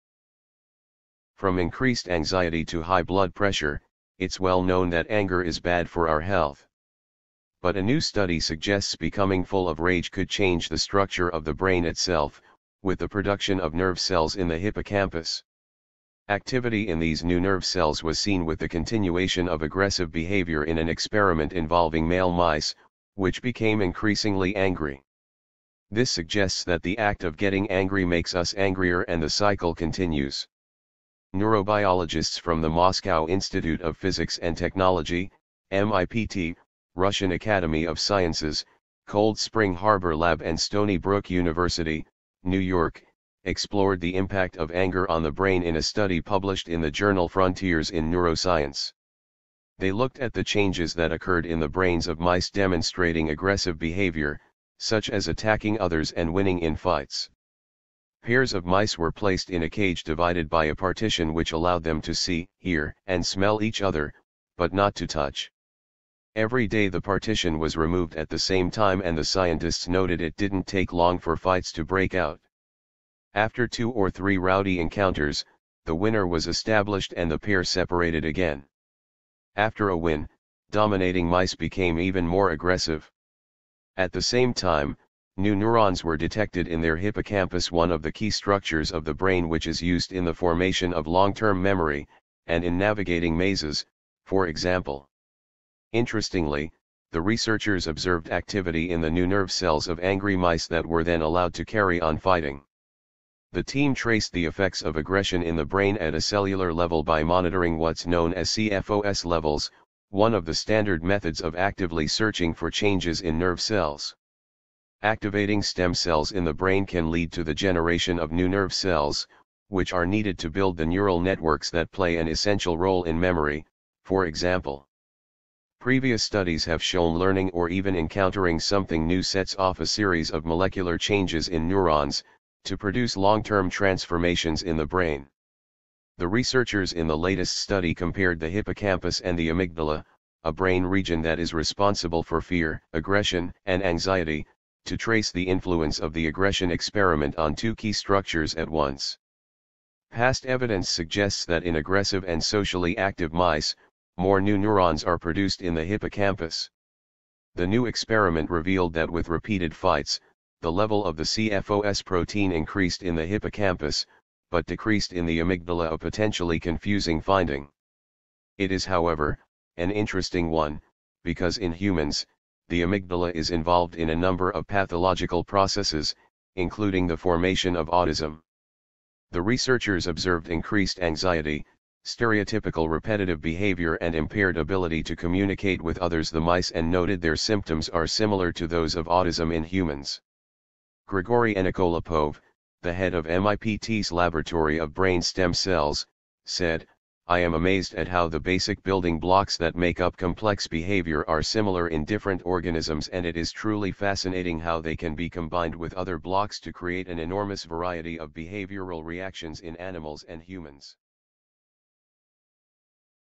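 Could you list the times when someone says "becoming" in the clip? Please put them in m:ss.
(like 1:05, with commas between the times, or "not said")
0:08.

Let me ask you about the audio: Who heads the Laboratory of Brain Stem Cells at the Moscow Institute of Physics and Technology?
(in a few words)
Grigory Enikolopov.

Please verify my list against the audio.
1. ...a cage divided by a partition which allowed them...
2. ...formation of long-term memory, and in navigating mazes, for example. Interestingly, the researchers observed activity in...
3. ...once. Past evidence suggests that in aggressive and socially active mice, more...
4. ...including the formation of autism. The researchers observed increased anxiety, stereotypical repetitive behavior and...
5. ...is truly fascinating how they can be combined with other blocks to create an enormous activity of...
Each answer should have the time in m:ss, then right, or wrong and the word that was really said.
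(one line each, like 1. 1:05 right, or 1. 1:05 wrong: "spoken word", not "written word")
1. 0:59 right
2. 1:30 right
3. 2:28 right
4. 2:56 right
5. 3:23 wrong: "variety", not "activity".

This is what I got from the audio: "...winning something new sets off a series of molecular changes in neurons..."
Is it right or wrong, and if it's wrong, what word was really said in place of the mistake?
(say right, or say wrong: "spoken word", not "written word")
wrong: "encountering", not "winning".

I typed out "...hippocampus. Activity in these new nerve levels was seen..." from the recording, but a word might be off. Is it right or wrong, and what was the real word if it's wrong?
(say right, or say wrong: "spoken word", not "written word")
wrong: "cells", not "levels".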